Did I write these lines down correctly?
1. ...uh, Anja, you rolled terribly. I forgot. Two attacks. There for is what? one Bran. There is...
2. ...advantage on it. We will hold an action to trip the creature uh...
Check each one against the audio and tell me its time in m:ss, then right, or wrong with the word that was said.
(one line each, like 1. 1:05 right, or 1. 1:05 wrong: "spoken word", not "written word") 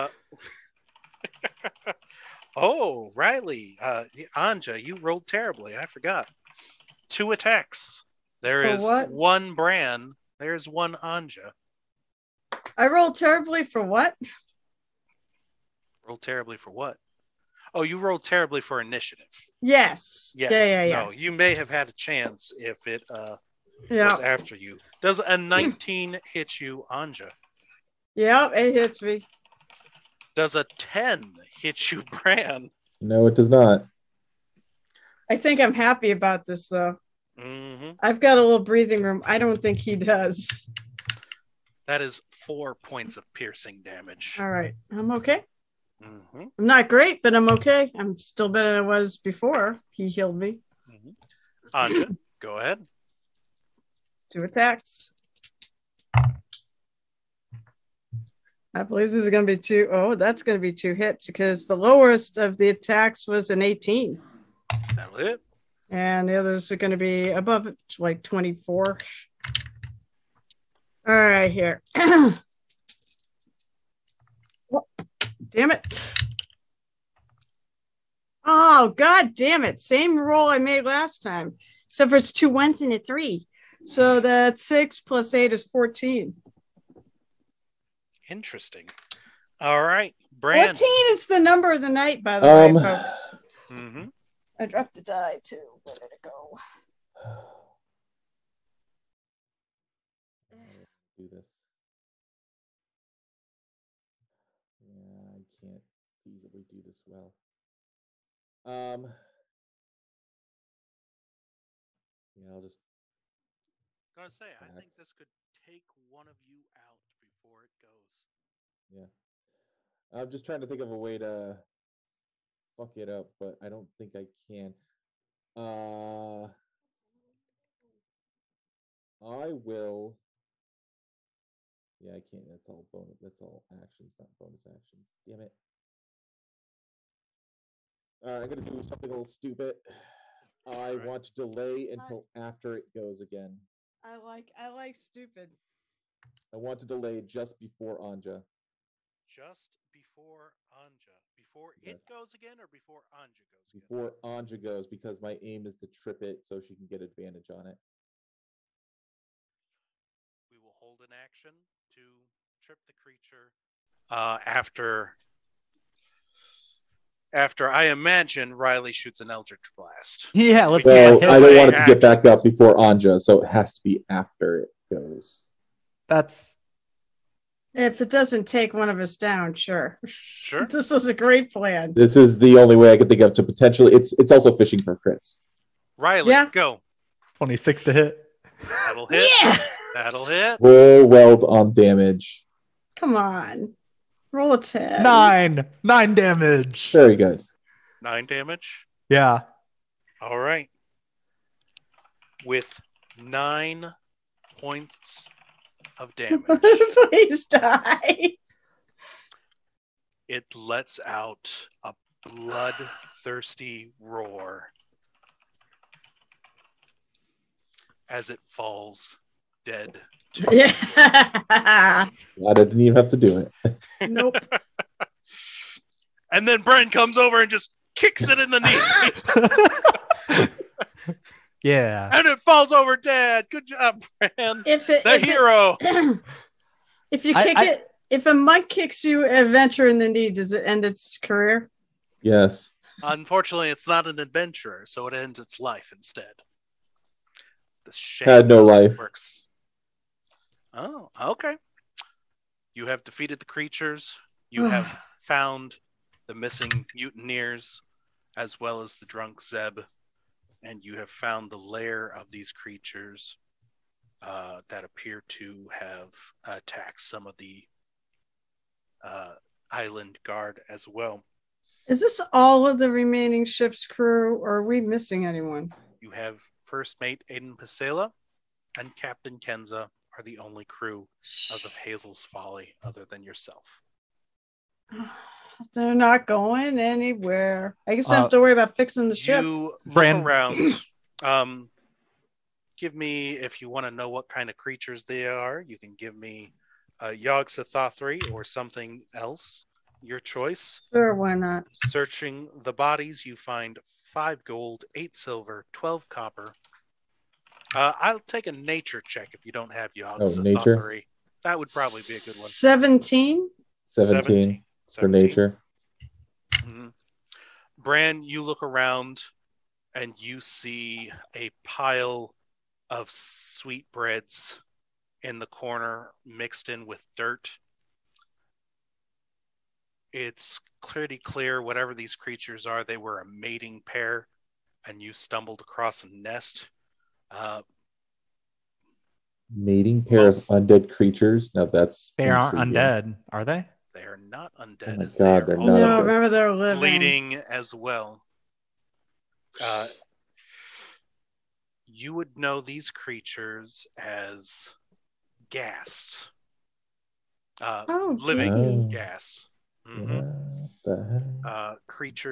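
1. 0:03 right
2. 2:37 right.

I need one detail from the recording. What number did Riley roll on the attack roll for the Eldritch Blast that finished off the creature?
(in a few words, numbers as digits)
26.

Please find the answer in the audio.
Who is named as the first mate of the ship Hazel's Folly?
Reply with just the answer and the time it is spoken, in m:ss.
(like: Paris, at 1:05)
Aiden Pasela, at 4:37.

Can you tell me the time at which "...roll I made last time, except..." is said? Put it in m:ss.
1:20.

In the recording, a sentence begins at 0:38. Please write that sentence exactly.
I've got a little breathing room.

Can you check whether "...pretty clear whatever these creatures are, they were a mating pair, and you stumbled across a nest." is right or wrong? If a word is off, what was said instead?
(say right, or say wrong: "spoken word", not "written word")
right.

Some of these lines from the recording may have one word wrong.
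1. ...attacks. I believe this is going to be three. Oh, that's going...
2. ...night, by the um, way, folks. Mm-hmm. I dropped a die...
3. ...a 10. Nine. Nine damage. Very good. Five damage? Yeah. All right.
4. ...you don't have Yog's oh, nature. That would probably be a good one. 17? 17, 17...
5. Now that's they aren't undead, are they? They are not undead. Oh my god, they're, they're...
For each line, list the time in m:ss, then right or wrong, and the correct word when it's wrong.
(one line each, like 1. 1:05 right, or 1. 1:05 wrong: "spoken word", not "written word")
1. 0:54 wrong: "two", not "three"
2. 1:31 right
3. 3:14 wrong: "Nine", not "Five"
4. 5:09 right
5. 5:41 right.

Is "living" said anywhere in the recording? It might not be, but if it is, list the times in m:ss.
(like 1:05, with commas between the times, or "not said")
5:46, 5:58.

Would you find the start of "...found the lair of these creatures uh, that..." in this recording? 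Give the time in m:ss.
4:21.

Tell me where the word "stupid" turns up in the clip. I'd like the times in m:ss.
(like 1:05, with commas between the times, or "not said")
2:19, 2:24.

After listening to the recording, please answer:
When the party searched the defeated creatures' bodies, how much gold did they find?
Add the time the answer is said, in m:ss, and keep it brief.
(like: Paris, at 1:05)
5 gold, at 5:04.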